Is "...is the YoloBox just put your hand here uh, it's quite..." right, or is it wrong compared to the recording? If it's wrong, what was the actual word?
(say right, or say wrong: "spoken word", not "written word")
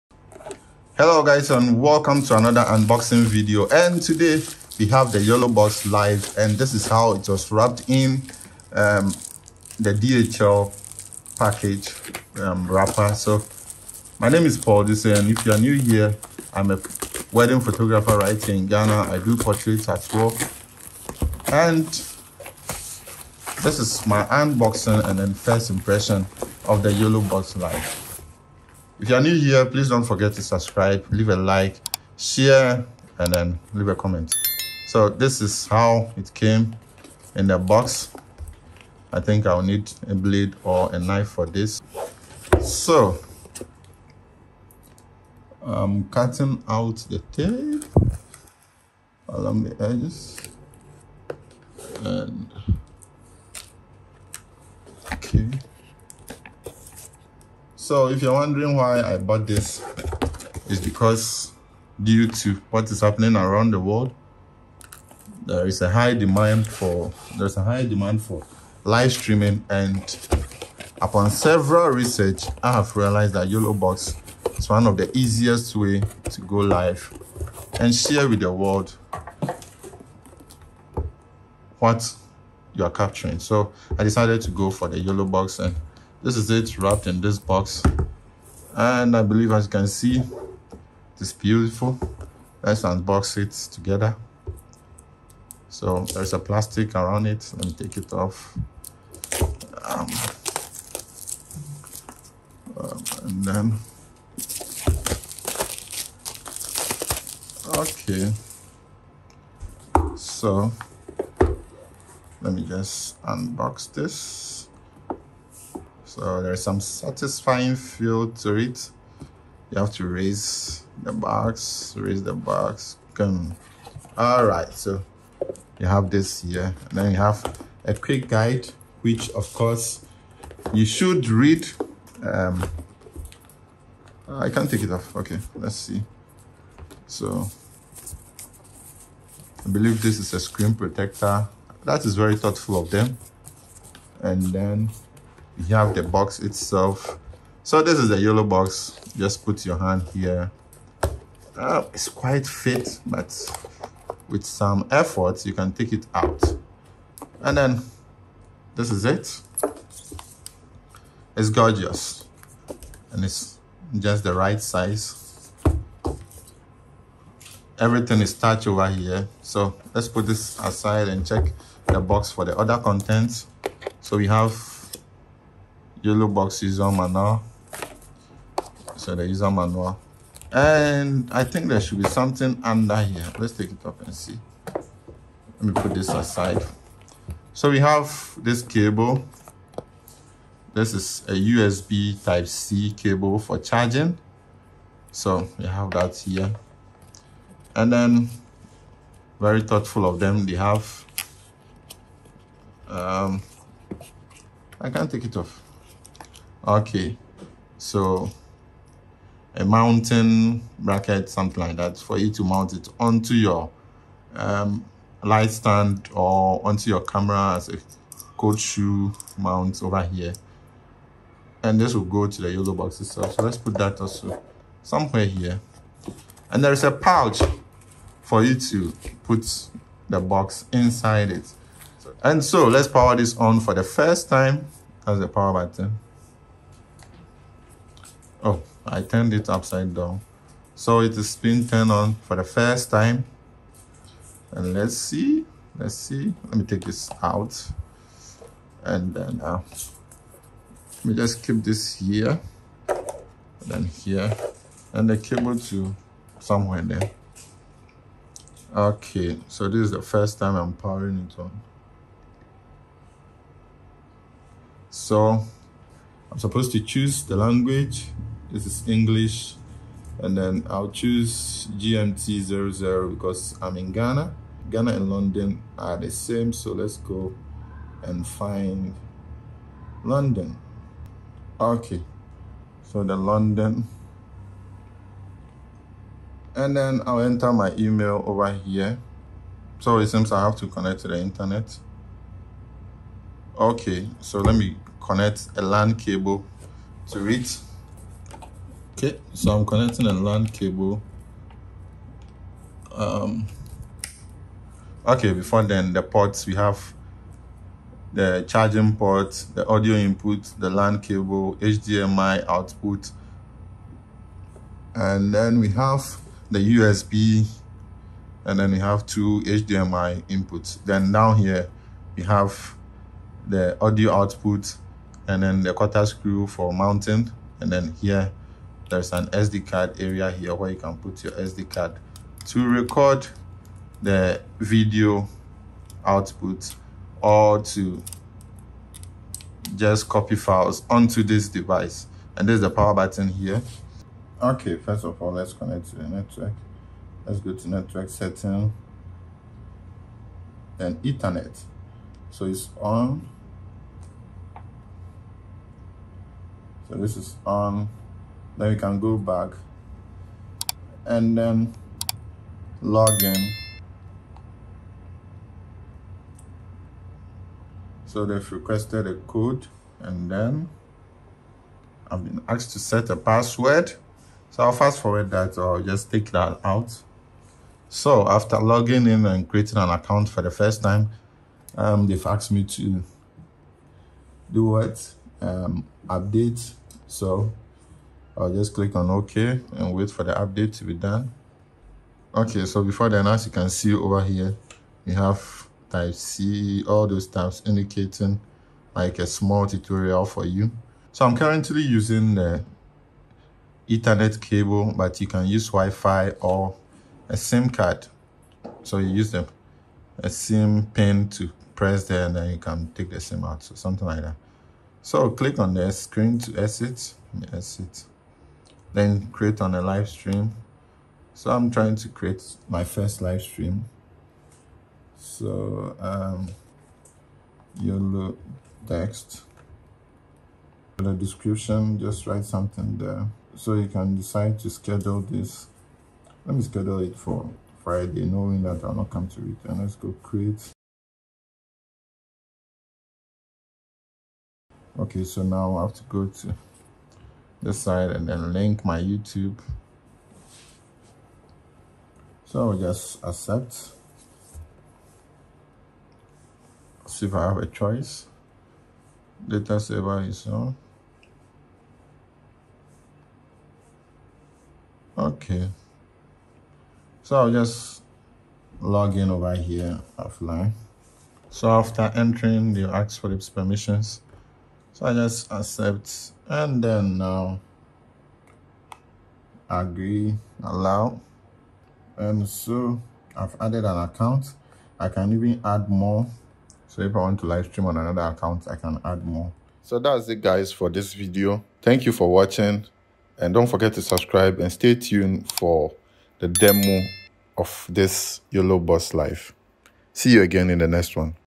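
right.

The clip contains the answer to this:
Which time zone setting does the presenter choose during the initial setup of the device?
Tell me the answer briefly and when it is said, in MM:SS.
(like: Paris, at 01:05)
GMT 00, at 04:31.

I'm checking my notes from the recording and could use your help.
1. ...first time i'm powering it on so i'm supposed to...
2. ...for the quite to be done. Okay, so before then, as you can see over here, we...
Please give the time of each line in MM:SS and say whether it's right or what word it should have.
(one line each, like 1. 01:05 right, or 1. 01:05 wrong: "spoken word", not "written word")
1. 04:20 right
2. 06:30 wrong: "update", not "quite".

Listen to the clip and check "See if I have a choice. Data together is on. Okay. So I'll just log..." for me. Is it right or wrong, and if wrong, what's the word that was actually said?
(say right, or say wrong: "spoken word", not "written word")
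wrong: "saver", not "together".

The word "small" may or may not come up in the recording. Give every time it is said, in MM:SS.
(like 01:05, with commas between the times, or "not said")
06:39.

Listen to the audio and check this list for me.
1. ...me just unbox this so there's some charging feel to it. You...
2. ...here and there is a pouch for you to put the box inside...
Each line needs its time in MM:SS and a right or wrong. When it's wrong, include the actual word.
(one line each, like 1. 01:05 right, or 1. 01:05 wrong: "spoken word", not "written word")
1. 01:52 wrong: "satisfying", not "charging"
2. 03:45 right.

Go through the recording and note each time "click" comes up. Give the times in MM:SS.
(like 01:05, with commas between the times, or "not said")
06:28, 06:55.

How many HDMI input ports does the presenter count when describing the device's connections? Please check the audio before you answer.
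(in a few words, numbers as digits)
2.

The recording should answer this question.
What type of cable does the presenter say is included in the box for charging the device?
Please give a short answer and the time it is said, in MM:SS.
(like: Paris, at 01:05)
USB type C, at 03:11.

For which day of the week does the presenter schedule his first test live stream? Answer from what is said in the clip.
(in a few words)
Friday.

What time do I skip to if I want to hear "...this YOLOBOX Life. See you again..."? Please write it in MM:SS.
08:17.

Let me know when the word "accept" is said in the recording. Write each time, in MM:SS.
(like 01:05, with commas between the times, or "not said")
07:33, 07:55.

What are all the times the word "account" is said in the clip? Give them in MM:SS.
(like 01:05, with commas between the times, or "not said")
06:19, 08:03, 08:08.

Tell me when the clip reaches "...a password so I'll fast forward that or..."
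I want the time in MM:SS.
06:13.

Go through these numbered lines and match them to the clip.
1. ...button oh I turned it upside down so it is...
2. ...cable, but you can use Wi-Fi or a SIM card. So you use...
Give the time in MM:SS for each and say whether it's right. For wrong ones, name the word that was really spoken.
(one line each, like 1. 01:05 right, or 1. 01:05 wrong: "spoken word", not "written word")
1. 03:55 right
2. 06:44 right.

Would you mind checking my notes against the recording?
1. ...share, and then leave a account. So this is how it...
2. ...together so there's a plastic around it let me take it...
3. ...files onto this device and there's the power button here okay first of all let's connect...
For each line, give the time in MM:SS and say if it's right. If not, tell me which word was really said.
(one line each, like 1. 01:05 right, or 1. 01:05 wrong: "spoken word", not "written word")
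1. 00:32 wrong: "comment", not "account"
2. 01:33 right
3. 05:40 right.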